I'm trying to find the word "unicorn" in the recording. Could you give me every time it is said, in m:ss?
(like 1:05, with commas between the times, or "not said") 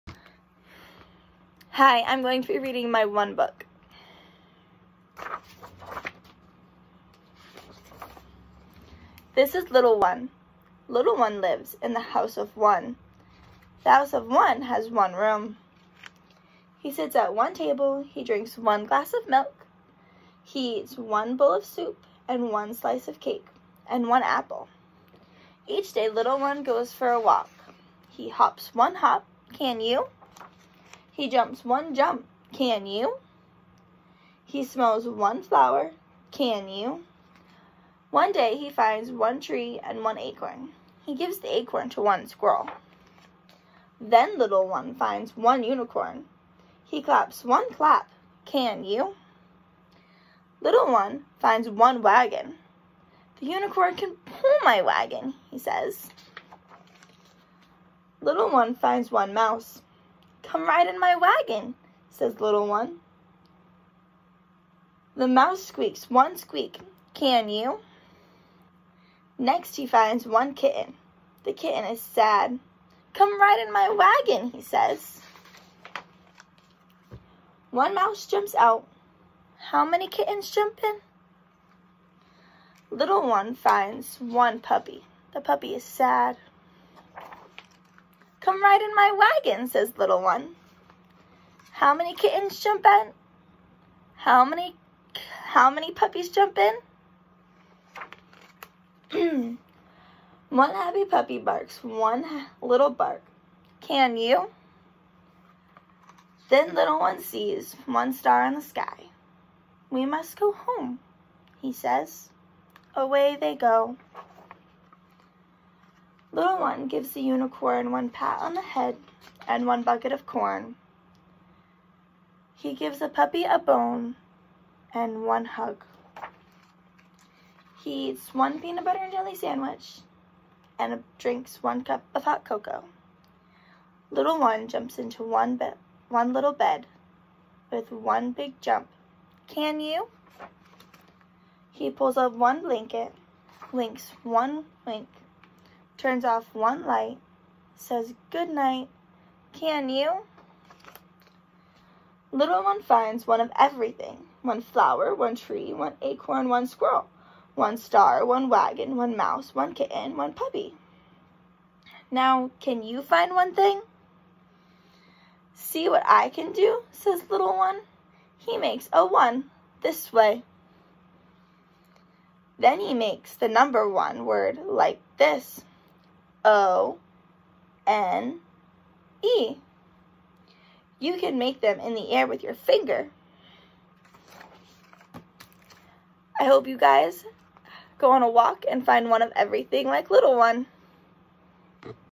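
0:45, 0:53, 1:57.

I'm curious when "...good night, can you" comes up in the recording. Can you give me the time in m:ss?
2:28.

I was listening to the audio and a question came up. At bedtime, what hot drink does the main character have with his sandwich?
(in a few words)
Hot cocoa.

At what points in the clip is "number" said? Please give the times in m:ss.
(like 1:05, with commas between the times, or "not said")
2:53.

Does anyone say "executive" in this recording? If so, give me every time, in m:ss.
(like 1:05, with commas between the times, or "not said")
not said.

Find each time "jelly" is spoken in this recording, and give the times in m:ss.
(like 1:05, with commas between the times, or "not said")
2:09.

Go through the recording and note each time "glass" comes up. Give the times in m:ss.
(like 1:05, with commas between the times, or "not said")
0:18.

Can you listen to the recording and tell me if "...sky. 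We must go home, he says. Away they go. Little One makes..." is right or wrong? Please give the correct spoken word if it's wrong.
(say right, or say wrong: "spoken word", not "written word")
wrong: "gives", not "makes".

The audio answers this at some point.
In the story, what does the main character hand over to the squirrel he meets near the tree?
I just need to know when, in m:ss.
0:41.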